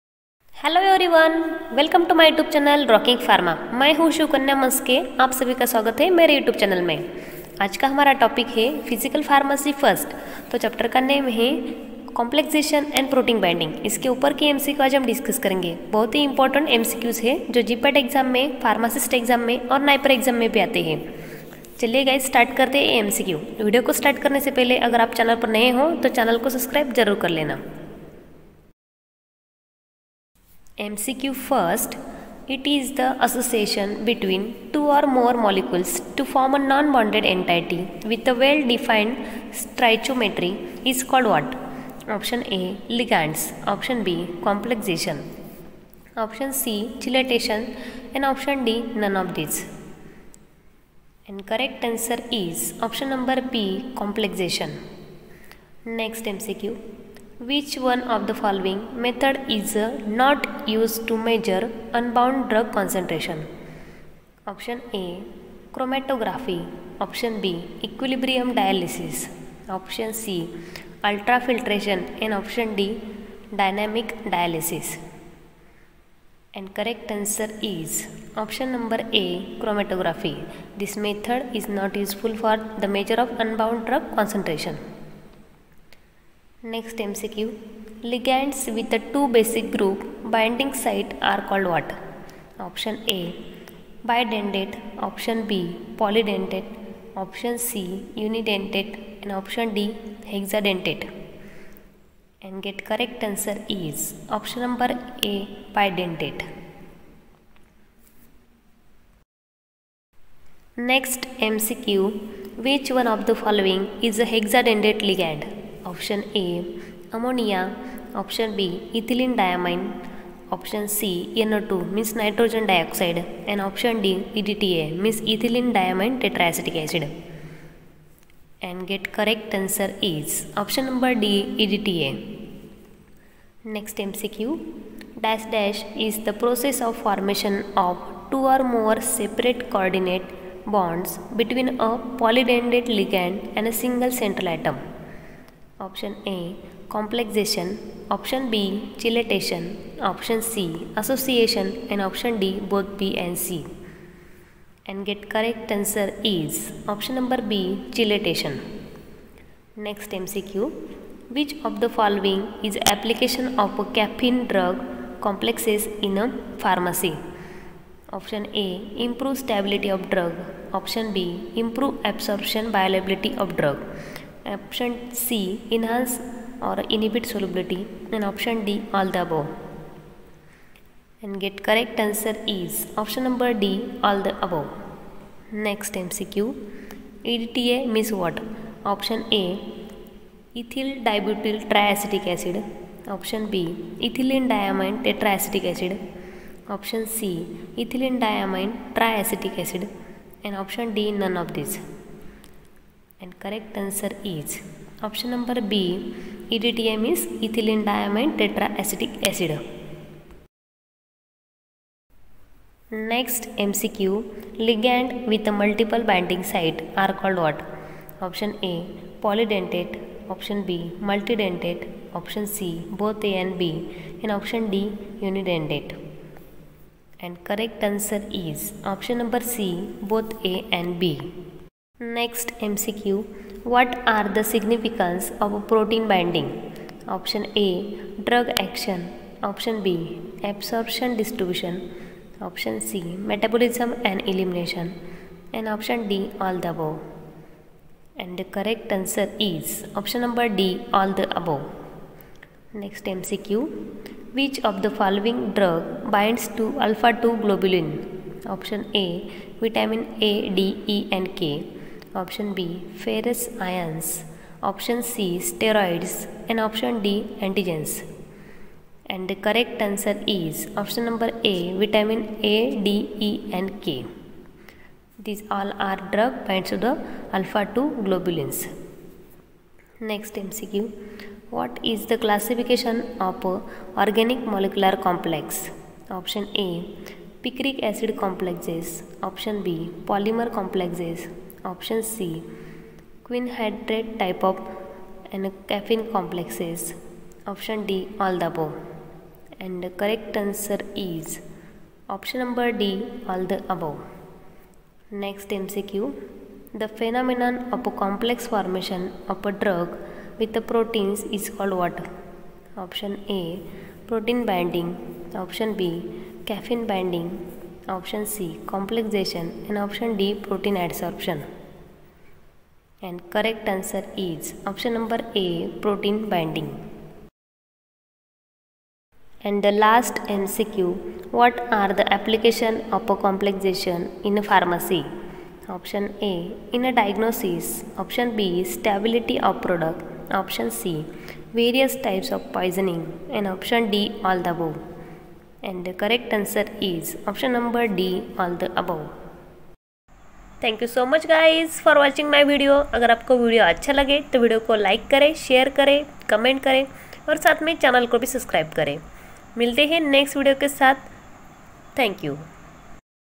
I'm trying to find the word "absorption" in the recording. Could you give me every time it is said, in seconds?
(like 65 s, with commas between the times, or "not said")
172 s, 240 s.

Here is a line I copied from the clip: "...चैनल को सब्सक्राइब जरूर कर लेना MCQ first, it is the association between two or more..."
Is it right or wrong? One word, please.
right.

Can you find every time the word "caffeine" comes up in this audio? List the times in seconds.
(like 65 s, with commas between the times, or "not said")
163 s, 295 s, 316 s.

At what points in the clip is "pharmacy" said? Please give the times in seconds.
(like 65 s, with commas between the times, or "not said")
166 s, 334 s.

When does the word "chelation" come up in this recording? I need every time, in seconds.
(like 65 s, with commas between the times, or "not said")
46 s, 148 s, 157 s.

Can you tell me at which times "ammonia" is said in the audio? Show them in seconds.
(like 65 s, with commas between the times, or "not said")
117 s.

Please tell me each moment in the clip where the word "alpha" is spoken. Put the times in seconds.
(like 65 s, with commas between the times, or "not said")
256 s, 277 s.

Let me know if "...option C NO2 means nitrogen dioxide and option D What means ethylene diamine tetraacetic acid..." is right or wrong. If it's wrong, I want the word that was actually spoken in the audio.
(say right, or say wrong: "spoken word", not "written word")
wrong: "EDTA", not "What".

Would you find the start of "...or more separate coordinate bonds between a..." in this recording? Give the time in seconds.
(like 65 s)
138 s.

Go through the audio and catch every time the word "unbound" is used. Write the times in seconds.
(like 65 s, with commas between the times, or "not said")
61 s, 83 s.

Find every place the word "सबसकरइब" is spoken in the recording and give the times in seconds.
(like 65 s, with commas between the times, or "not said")
26 s, 358 s.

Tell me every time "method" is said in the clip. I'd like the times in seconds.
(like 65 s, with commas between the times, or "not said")
59 s, 80 s.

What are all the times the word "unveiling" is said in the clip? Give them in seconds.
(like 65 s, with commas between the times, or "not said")
not said.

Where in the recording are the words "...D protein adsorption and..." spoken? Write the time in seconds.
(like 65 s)
320 s.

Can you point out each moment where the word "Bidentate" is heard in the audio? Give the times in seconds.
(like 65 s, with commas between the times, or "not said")
94 s, 105 s.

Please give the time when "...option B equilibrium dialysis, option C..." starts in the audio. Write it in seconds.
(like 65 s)
67 s.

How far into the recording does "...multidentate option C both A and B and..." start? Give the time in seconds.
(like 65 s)
221 s.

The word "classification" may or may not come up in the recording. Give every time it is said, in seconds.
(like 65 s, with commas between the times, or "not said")
282 s.